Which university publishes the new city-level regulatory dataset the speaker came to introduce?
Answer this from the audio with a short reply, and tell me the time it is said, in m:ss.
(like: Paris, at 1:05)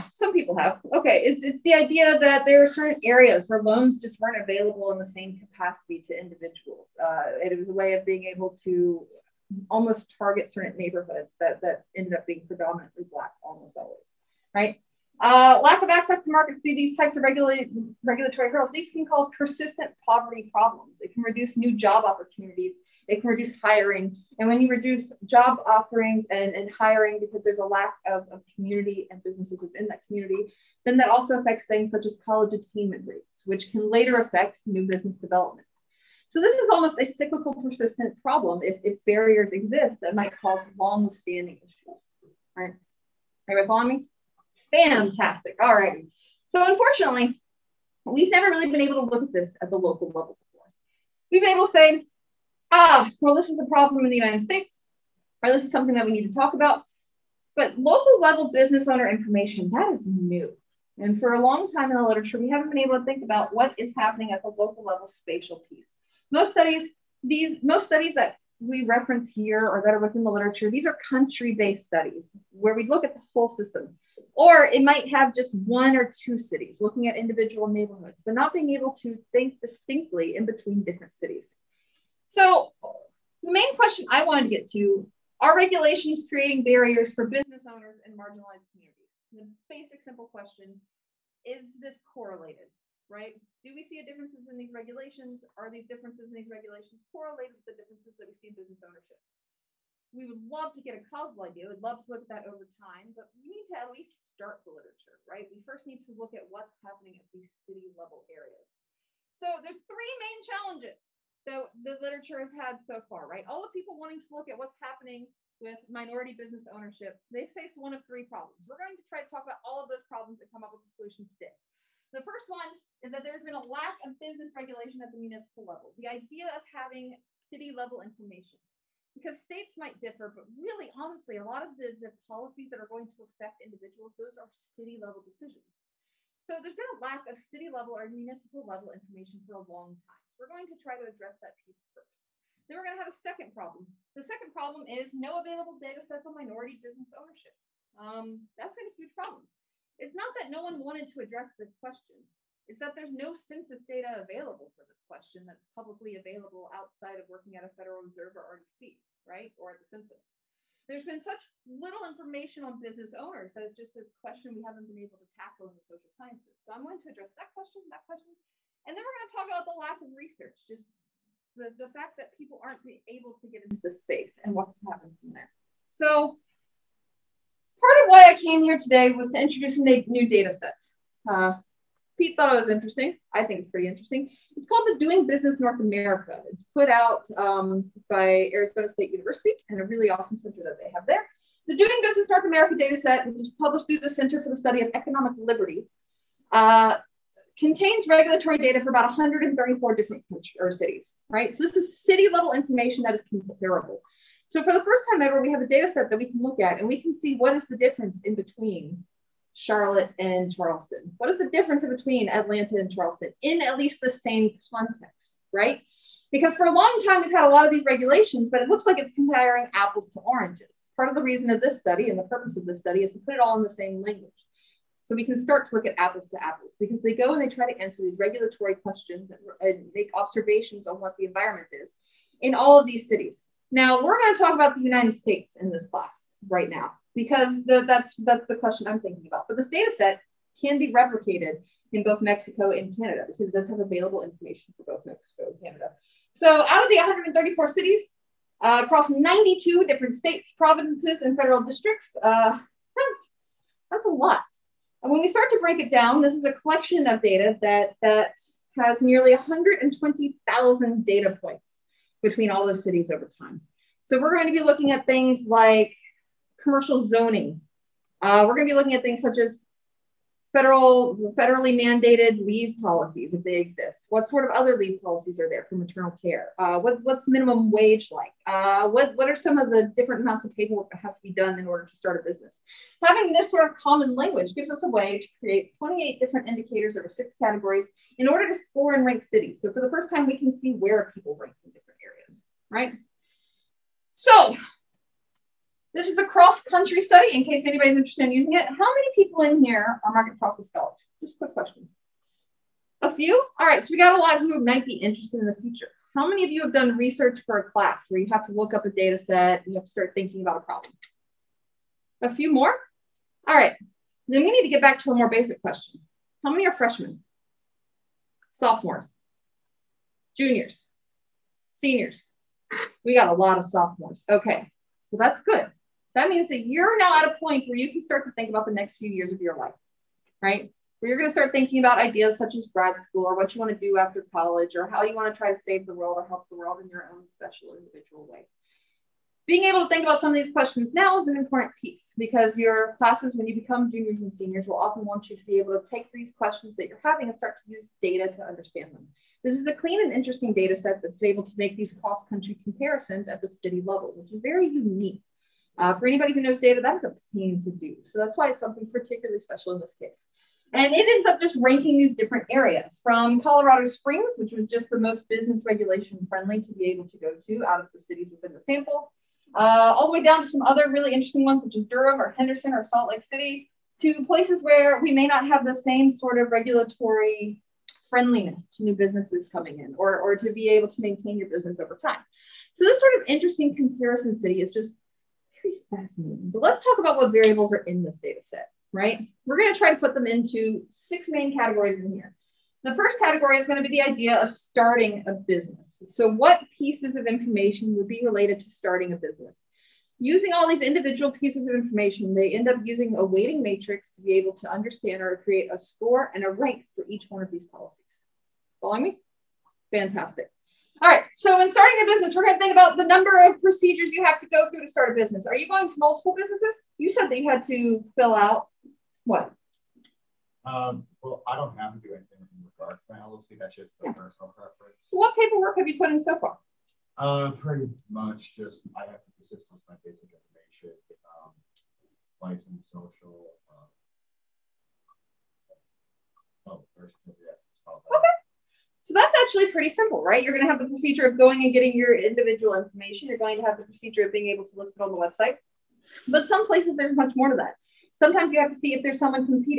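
Arizona State University, at 3:08.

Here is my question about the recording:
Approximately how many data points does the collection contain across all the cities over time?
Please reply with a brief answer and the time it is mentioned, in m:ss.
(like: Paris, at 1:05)
120,000, at 4:19.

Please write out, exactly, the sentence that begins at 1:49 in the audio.
So there's three main challenges that the literature has had so far, right?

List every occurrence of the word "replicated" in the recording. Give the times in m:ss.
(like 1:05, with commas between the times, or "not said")
4:00.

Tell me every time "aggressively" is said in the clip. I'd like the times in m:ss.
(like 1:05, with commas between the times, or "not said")
not said.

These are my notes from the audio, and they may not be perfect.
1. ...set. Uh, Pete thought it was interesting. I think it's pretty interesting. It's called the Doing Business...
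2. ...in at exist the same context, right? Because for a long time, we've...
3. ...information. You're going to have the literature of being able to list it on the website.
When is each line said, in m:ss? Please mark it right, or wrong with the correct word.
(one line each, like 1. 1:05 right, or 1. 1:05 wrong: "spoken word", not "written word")
1. 3:00 right
2. 3:33 wrong: "least", not "exist"
3. 7:22 wrong: "procedure", not "literature".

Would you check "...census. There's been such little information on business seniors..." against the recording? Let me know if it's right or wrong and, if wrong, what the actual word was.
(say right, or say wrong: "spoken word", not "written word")
wrong: "owners", not "seniors".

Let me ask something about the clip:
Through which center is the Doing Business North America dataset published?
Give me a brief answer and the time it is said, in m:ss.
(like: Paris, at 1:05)
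Center for the Study of Economic Liberty, at 3:14.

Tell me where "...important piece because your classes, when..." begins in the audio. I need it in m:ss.
5:41.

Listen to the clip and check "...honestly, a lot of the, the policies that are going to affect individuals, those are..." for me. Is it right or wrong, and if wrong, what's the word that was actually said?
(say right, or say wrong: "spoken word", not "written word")
right.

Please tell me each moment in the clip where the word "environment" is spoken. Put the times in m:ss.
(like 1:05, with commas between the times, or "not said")
3:51.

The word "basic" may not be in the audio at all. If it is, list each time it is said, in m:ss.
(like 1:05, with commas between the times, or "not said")
1:29, 5:15, 7:10.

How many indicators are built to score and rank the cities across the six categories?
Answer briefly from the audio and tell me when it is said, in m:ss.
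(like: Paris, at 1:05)
28, at 4:45.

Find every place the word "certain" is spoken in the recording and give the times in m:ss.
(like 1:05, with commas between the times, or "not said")
0:02, 0:10.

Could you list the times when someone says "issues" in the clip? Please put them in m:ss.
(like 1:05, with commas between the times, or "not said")
0:41.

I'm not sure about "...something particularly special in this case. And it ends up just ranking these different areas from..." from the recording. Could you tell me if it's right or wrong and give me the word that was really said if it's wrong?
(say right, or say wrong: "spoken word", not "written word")
right.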